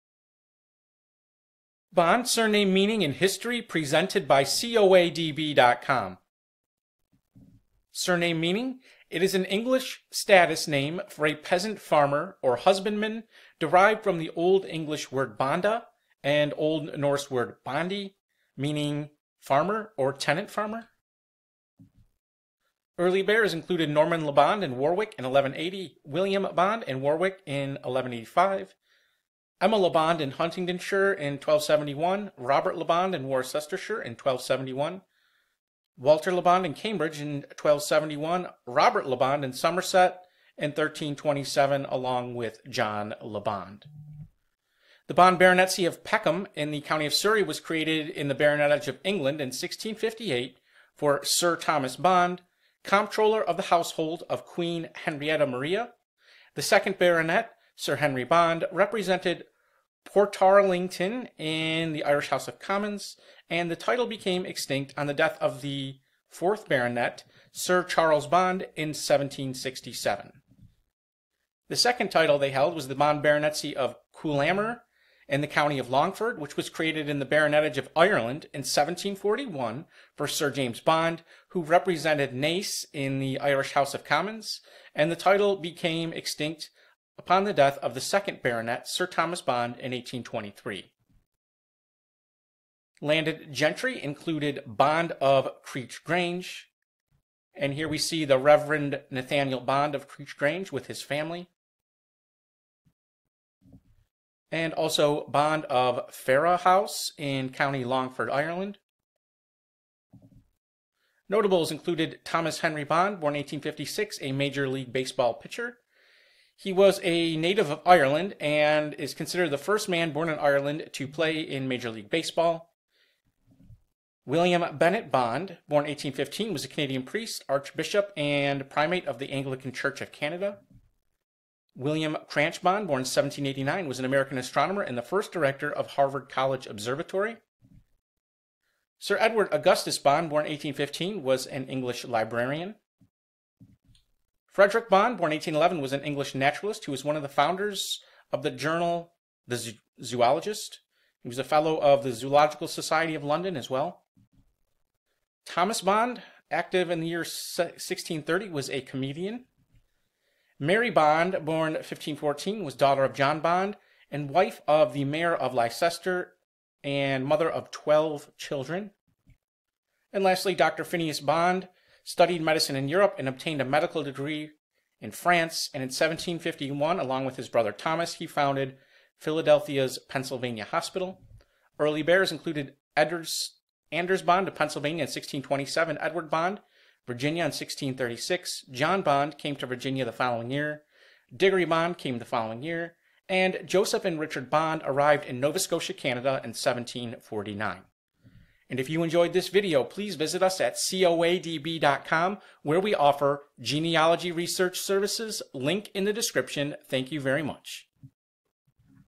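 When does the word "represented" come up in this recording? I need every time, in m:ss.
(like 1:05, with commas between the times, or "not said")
0:58, 1:21.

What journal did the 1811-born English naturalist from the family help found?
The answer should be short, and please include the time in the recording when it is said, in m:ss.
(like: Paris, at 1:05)
The Zoologist, at 2:29.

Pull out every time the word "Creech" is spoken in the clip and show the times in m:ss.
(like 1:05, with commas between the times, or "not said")
1:35, 1:40.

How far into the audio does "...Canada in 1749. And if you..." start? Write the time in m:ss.
3:15.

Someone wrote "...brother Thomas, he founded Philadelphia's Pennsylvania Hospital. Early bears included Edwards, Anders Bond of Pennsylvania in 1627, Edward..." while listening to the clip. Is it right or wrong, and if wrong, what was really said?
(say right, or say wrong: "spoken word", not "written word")
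right.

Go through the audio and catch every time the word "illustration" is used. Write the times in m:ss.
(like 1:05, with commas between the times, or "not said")
not said.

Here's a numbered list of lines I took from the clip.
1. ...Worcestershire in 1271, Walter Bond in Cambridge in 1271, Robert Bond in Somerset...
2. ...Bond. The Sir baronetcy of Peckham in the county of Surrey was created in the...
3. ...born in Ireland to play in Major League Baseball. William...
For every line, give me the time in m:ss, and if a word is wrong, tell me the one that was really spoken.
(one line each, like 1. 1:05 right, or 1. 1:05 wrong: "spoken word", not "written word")
1. 0:33 right
2. 0:43 wrong: "Bond", not "Sir"
3. 2:00 right.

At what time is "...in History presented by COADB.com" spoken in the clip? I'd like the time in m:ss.
0:03.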